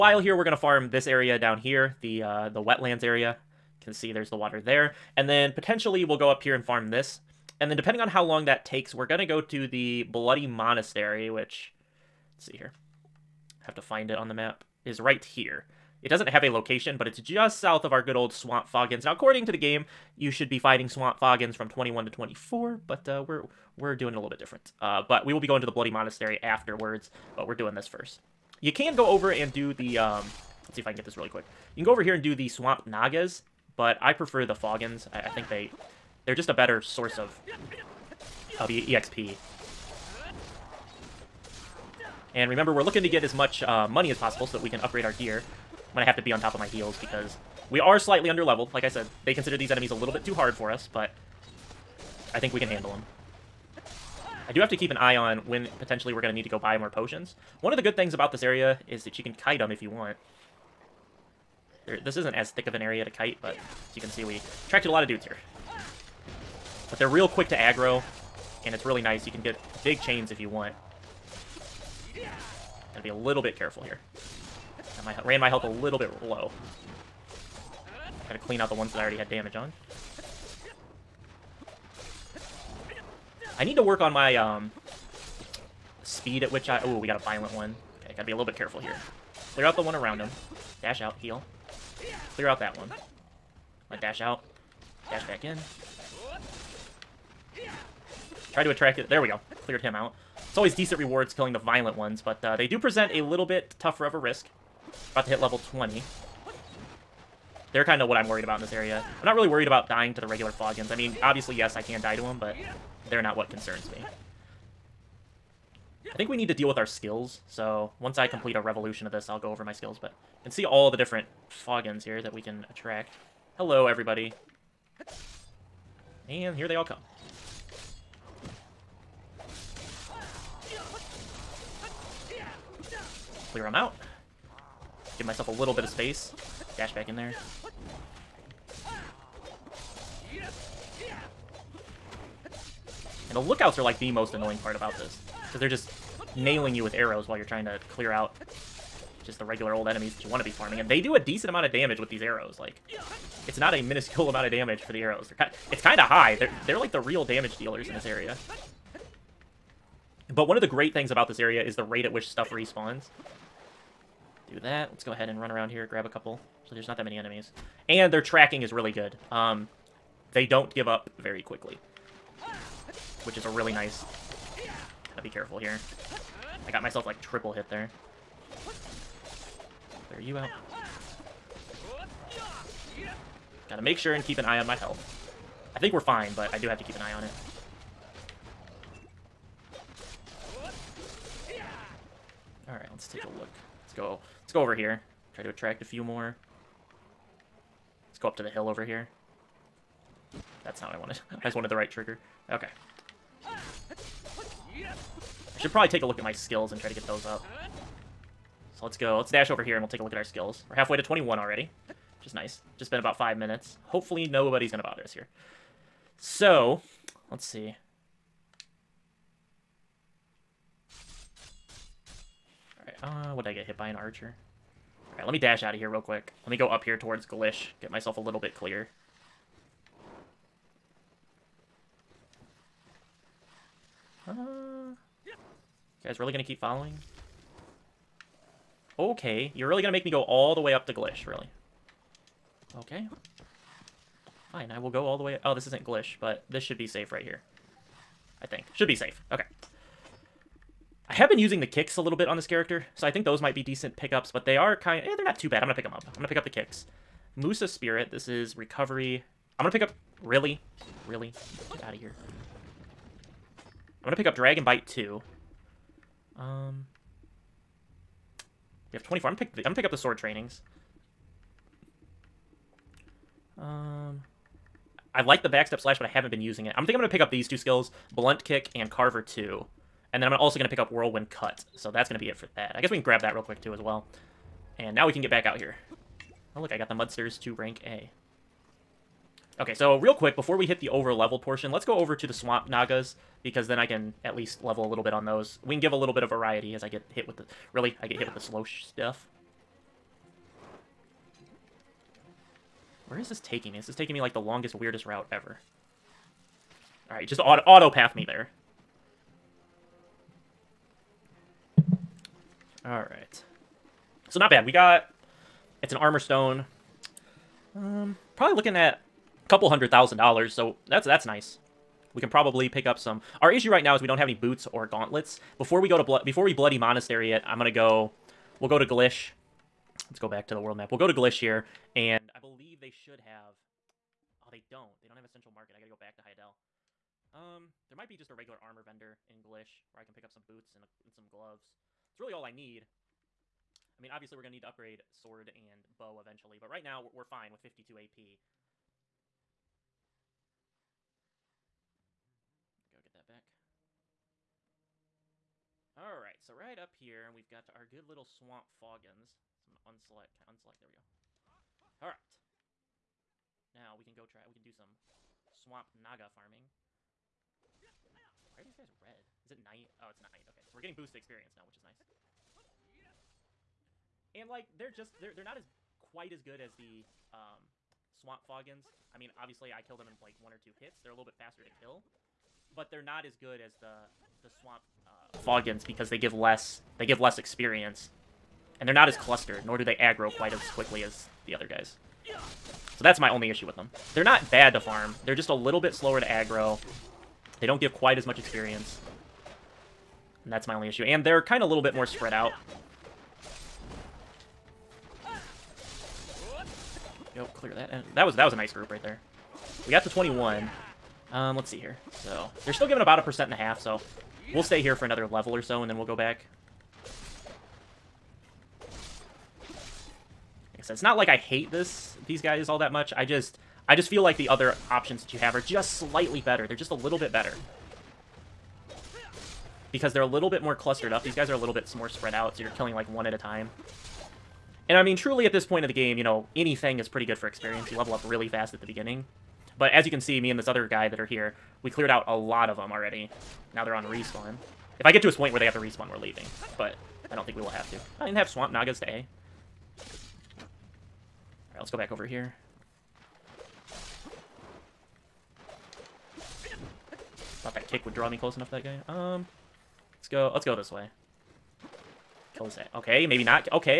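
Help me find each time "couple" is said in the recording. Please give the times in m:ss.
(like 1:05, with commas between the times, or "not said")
2:46, 5:19.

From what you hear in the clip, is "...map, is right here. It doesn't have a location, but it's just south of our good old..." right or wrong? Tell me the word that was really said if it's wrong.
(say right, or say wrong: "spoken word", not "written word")
right.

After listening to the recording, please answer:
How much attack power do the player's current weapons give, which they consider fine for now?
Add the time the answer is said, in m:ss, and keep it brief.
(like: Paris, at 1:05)
52 AP, at 5:47.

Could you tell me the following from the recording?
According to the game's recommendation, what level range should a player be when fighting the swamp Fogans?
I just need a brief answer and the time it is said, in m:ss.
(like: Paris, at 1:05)
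21 to 24, at 0:21.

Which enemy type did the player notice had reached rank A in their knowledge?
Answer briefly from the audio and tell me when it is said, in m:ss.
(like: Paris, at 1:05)
mudsters, at 4:46.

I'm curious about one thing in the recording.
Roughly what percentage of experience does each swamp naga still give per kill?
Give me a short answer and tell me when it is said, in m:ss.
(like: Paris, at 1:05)
1.5%, at 6:53.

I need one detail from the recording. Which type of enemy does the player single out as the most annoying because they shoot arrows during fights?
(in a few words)
lookouts.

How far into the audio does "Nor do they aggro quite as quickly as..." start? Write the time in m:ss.
6:29.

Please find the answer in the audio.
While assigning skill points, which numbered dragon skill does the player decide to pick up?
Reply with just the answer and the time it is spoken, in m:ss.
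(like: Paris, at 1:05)
Dragon Bite 2, at 4:24.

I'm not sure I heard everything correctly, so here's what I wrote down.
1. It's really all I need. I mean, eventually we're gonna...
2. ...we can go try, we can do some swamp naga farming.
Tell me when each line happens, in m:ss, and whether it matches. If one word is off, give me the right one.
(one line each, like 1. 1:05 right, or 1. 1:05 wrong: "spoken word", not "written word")
1. 5:42 wrong: "obviously", not "eventually"
2. 6:03 right.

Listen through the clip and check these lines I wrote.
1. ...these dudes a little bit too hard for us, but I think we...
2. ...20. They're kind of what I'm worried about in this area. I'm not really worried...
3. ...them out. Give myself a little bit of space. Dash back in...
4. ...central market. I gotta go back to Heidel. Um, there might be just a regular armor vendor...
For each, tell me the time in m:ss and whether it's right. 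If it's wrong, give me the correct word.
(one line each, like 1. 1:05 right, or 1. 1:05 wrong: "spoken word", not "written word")
1. 0:49 wrong: "enemies", not "dudes"
2. 1:45 right
3. 2:13 right
4. 5:35 right.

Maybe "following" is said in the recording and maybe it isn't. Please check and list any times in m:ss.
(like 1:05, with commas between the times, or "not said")
3:56.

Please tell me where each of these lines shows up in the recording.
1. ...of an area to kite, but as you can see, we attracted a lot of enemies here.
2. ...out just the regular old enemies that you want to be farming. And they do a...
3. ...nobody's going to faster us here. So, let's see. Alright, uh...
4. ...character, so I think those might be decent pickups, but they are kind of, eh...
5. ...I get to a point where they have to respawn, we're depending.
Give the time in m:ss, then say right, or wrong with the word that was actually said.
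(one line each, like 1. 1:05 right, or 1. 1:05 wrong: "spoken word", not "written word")
1. 1:02 wrong: "dudes", not "enemies"
2. 2:28 right
3. 3:34 wrong: "bother", not "faster"
4. 4:12 right
5. 7:25 wrong: "leaving", not "depending".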